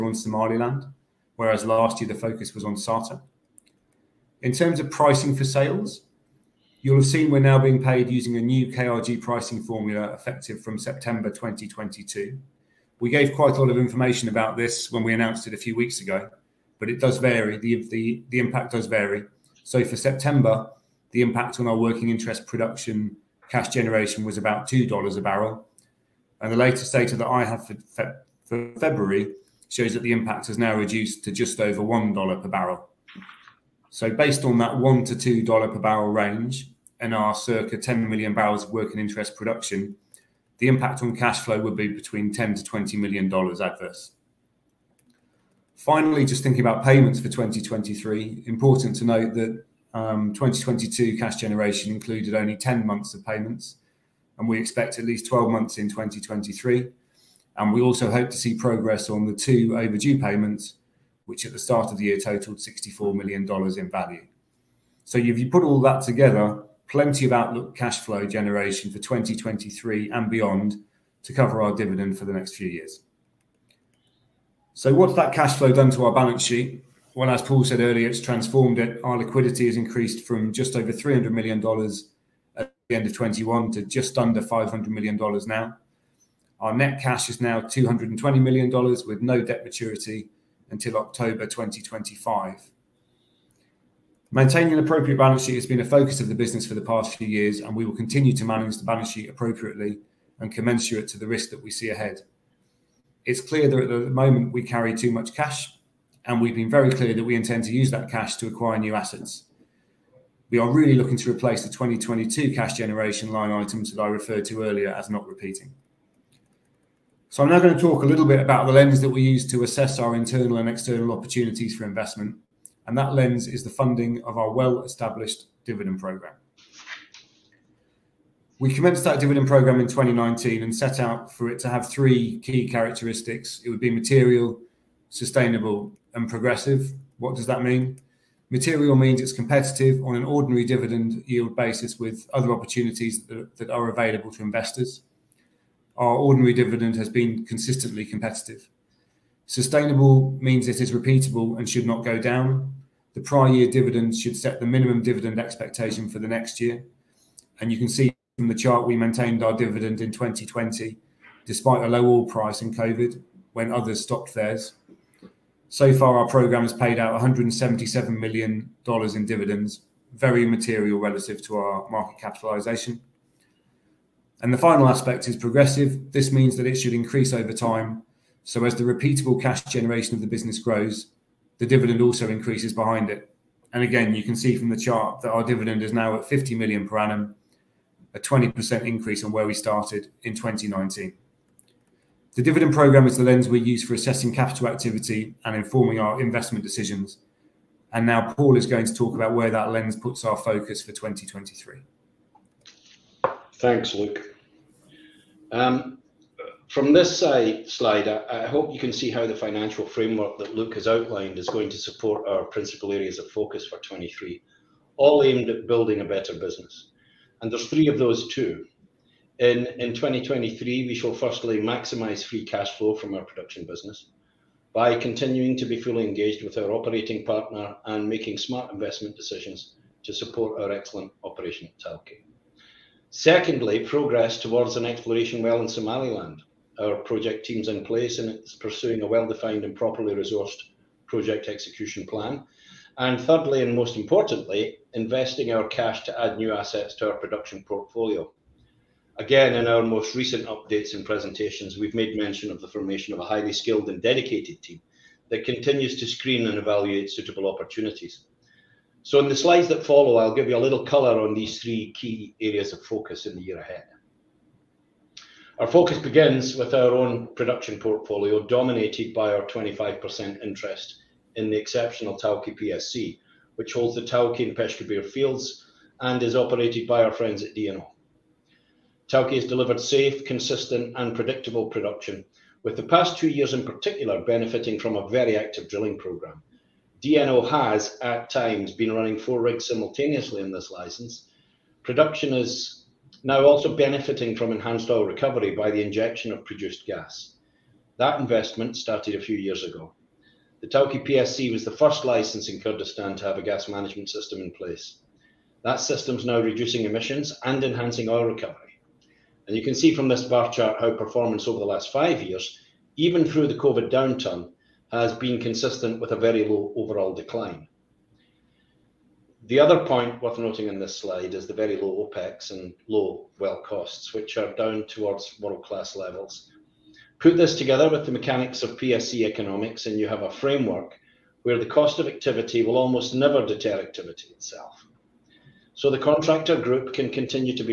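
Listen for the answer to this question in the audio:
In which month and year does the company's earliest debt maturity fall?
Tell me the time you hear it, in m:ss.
1:30.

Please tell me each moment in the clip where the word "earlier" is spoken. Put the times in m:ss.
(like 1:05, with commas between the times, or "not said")
1:17, 1:54.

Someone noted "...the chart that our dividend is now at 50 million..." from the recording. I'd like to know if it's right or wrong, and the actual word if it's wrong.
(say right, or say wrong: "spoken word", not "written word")
right.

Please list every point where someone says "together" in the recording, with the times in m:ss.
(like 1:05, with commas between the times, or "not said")
1:06, 5:27.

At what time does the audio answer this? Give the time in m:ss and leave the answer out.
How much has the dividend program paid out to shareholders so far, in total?
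2:47.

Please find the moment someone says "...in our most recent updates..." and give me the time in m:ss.
4:09.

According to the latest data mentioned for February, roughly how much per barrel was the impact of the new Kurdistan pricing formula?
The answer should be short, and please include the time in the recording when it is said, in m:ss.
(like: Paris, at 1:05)
just over $1, at 0:31.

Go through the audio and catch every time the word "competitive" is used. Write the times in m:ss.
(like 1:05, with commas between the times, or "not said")
2:19, 2:28.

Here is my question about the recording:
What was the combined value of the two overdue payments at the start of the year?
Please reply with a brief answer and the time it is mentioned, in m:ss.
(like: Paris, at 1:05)
$64 million, at 1:02.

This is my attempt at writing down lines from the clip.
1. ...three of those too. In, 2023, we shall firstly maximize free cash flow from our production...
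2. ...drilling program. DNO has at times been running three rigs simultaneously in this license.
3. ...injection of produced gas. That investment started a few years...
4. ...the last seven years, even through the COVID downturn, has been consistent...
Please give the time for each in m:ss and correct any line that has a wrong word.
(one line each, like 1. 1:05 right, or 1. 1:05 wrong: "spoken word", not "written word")
1. 3:37 right
2. 4:45 wrong: "four", not "three"
3. 4:55 right
4. 5:11 wrong: "five", not "seven".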